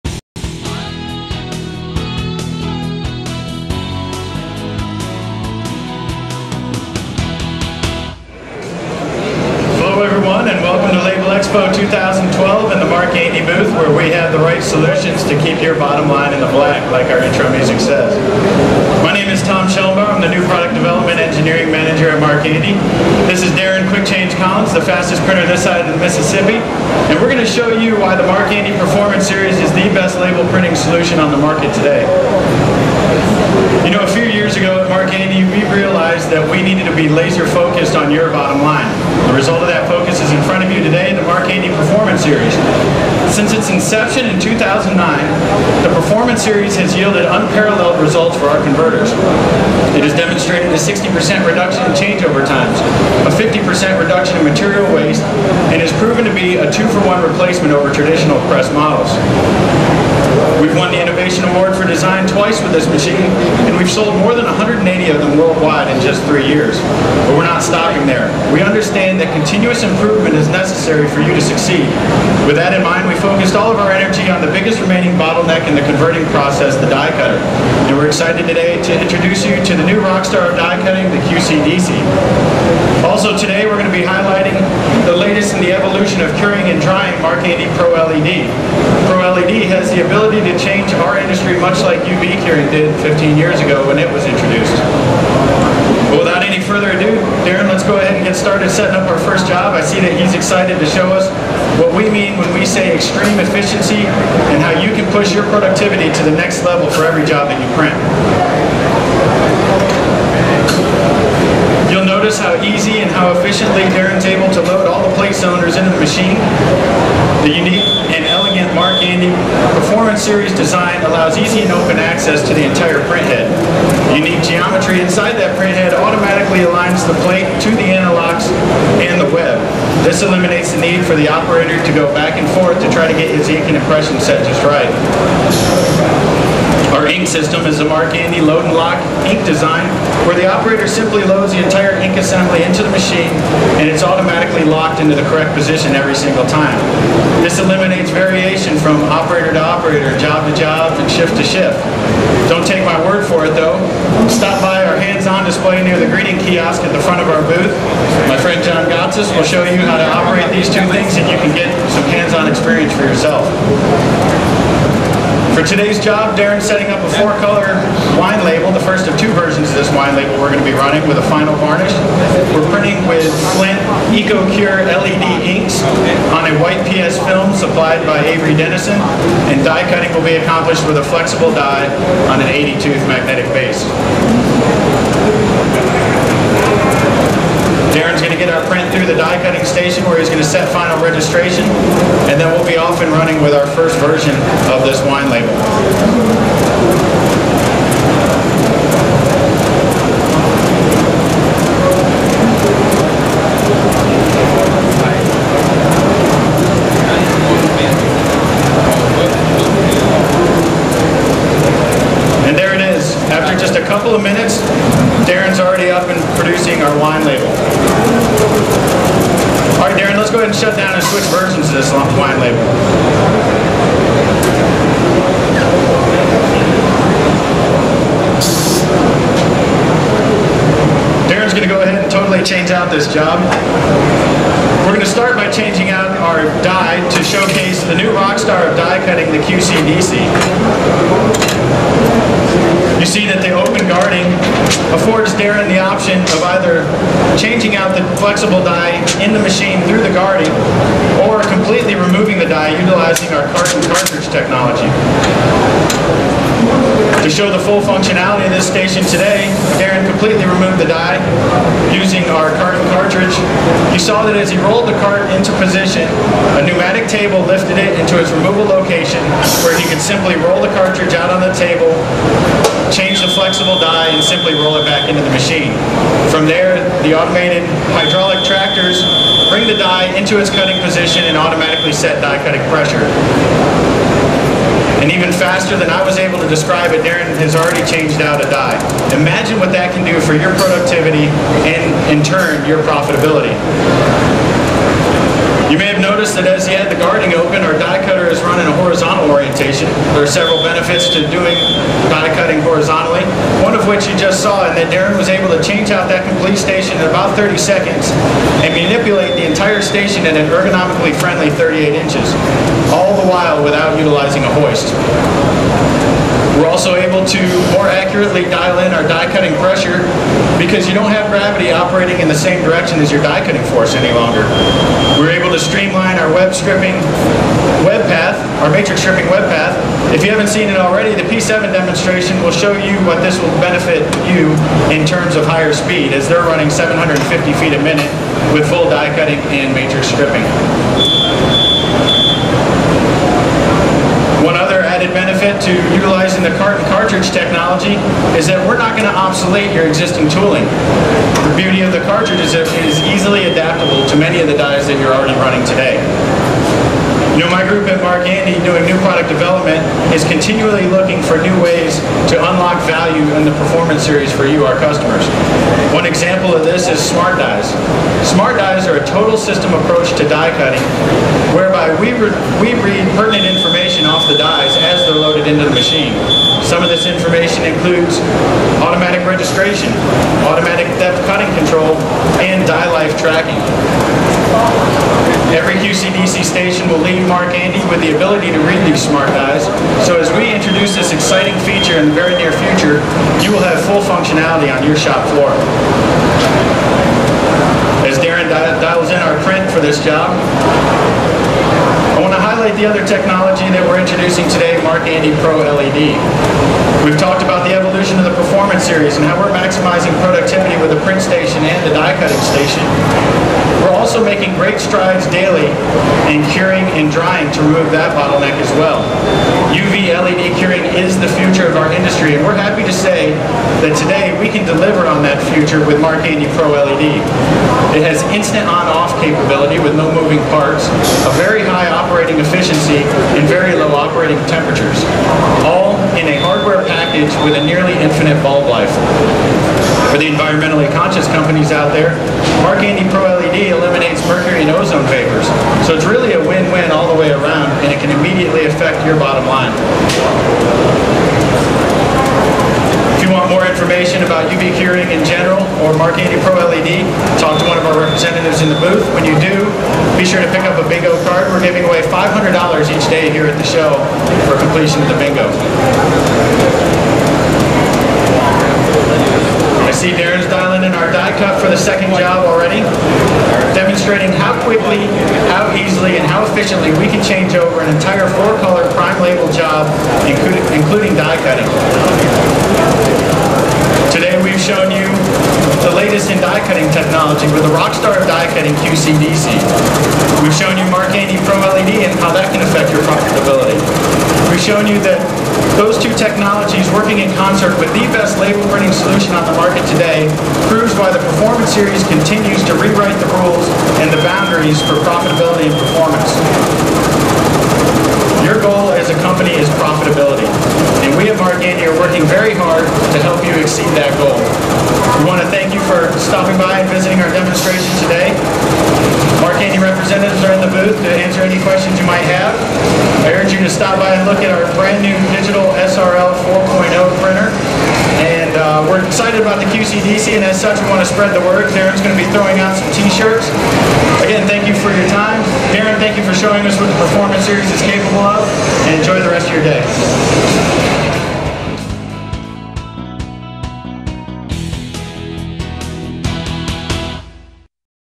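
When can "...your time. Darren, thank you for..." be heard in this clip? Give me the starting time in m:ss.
8:54.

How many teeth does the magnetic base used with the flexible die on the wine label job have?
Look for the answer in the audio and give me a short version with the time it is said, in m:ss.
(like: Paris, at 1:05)
80, at 3:02.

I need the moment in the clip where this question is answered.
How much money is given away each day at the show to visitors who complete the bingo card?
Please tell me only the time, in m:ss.
7:42.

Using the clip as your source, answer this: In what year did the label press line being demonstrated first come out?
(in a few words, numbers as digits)
2009.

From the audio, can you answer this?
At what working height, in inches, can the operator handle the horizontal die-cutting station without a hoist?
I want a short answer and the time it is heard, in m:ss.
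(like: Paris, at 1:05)
38 inches, at 5:11.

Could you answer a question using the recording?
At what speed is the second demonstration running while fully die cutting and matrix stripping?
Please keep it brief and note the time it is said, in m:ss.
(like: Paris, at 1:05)
750 feet a minute, at 5:36.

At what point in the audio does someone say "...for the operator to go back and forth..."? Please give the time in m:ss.
2:11.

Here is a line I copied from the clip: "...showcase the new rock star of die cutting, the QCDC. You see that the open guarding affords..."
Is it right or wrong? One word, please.
right.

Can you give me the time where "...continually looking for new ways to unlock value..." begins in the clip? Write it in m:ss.
6:00.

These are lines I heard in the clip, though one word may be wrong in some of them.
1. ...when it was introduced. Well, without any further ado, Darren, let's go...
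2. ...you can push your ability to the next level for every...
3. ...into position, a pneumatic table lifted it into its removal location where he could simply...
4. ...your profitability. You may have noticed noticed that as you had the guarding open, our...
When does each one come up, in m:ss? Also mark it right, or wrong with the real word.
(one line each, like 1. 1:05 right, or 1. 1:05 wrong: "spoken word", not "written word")
1. 1:33 right
2. 1:44 wrong: "productivity", not "ability"
3. 4:25 right
4. 4:52 right.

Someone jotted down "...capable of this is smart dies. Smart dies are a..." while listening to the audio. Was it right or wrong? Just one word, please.
wrong.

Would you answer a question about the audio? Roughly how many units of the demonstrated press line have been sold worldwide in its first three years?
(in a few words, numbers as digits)
180.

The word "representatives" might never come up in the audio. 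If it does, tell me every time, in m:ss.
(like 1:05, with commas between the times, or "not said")
7:37, 8:39.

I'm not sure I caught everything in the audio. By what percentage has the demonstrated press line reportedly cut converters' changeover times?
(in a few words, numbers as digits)
60%.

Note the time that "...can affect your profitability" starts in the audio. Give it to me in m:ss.
8:12.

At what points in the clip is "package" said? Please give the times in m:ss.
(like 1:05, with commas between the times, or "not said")
7:16.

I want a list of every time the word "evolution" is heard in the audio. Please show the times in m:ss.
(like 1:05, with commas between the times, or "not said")
1:25, 6:47.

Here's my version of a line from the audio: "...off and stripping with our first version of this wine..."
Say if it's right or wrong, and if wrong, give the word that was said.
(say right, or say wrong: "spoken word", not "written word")
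wrong: "running", not "stripping".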